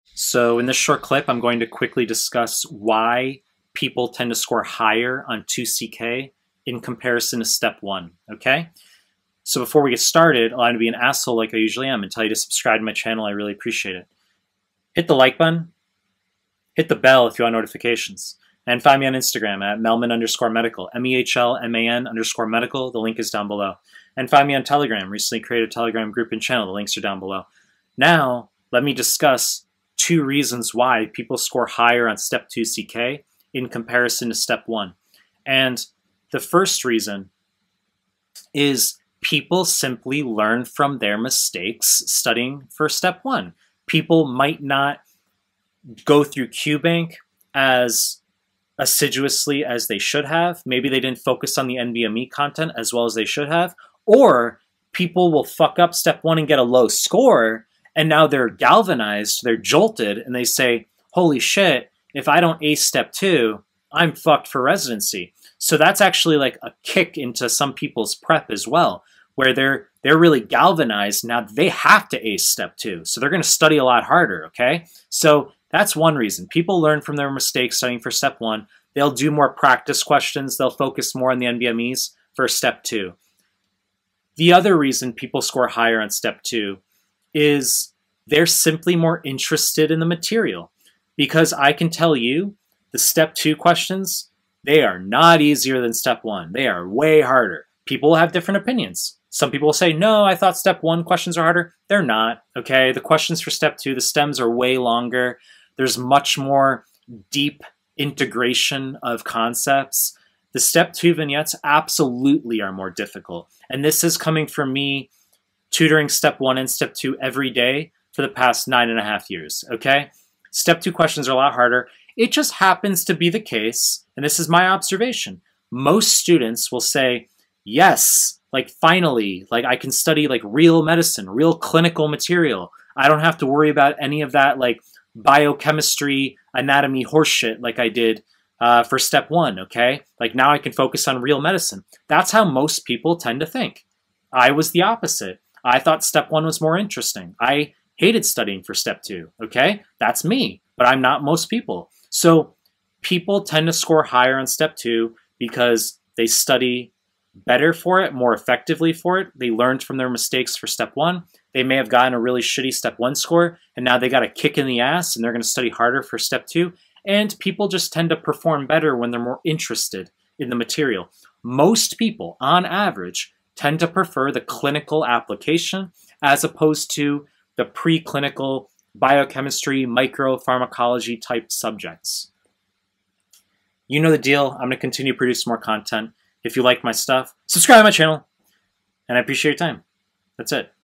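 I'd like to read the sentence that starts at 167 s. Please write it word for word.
And people just tend to perform better when they're more interested in the material.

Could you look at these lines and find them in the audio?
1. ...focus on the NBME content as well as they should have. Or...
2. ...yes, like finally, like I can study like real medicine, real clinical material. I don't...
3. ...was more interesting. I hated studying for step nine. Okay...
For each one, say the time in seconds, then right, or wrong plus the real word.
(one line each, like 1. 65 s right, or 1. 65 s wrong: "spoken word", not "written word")
1. 51 s right
2. 127 s right
3. 146 s wrong: "two", not "nine".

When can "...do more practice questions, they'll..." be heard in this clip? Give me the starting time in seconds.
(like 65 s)
79 s.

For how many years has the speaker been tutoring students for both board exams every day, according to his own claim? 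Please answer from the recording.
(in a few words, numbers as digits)
9.5 years.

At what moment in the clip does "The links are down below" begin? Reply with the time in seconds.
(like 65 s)
26 s.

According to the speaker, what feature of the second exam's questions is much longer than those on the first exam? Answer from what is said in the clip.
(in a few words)
The stems.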